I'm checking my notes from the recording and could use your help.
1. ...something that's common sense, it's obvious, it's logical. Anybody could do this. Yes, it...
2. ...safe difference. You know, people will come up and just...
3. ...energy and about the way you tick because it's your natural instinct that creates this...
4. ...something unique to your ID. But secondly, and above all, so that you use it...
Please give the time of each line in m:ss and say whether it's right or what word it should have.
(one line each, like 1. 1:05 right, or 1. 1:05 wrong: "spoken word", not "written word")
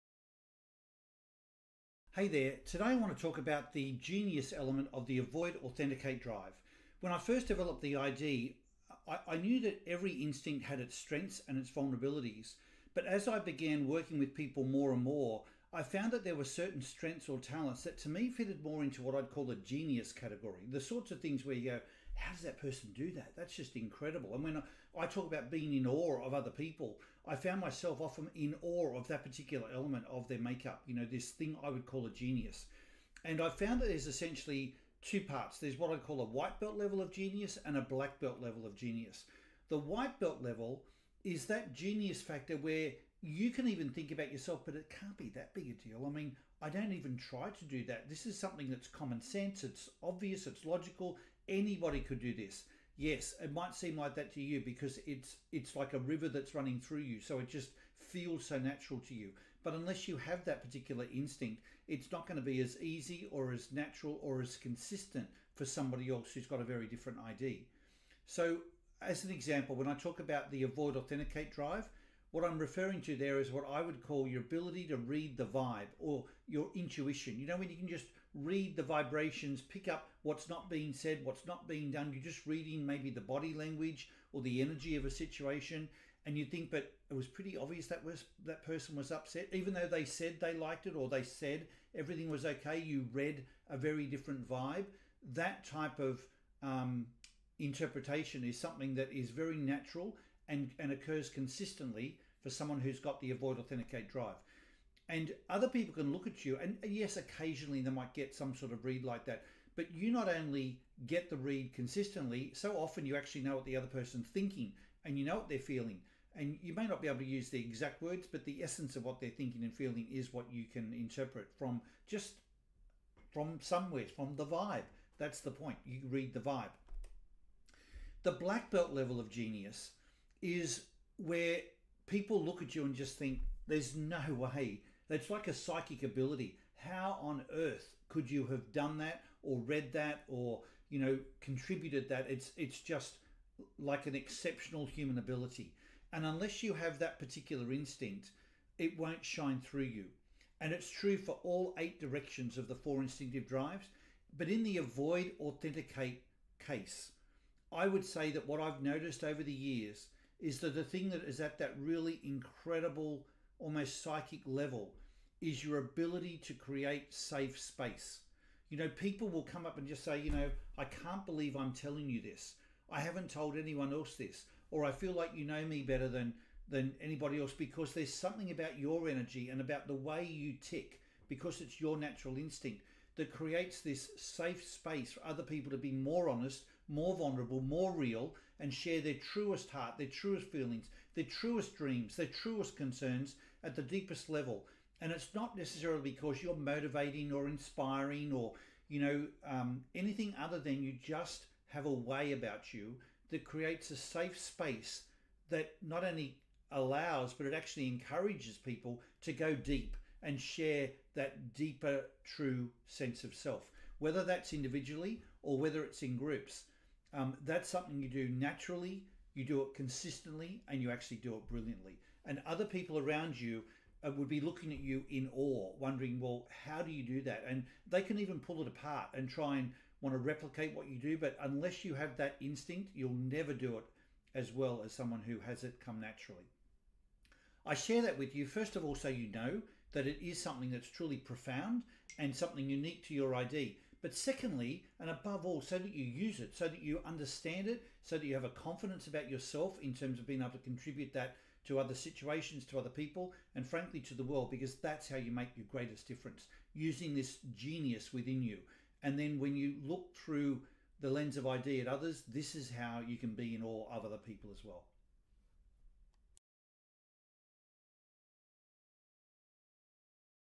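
1. 0:48 right
2. 2:47 wrong: "space", not "difference"
3. 2:59 right
4. 4:02 right.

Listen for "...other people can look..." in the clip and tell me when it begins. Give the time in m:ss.
1:45.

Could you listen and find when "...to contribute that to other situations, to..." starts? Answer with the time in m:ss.
4:10.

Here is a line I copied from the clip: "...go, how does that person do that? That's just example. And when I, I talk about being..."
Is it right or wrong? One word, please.
wrong.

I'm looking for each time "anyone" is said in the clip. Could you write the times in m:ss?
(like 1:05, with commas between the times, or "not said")
2:53.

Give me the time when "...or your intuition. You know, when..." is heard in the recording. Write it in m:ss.
1:15.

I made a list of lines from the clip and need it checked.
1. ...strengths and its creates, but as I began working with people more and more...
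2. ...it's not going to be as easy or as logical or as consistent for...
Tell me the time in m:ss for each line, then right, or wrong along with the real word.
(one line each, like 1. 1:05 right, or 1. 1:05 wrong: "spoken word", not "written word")
1. 0:10 wrong: "vulnerabilities", not "creates"
2. 1:01 wrong: "natural", not "logical".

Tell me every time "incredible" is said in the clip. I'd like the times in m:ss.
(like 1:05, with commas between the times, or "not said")
0:23, 2:42.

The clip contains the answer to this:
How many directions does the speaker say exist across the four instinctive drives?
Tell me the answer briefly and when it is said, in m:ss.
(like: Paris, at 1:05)
8, at 2:31.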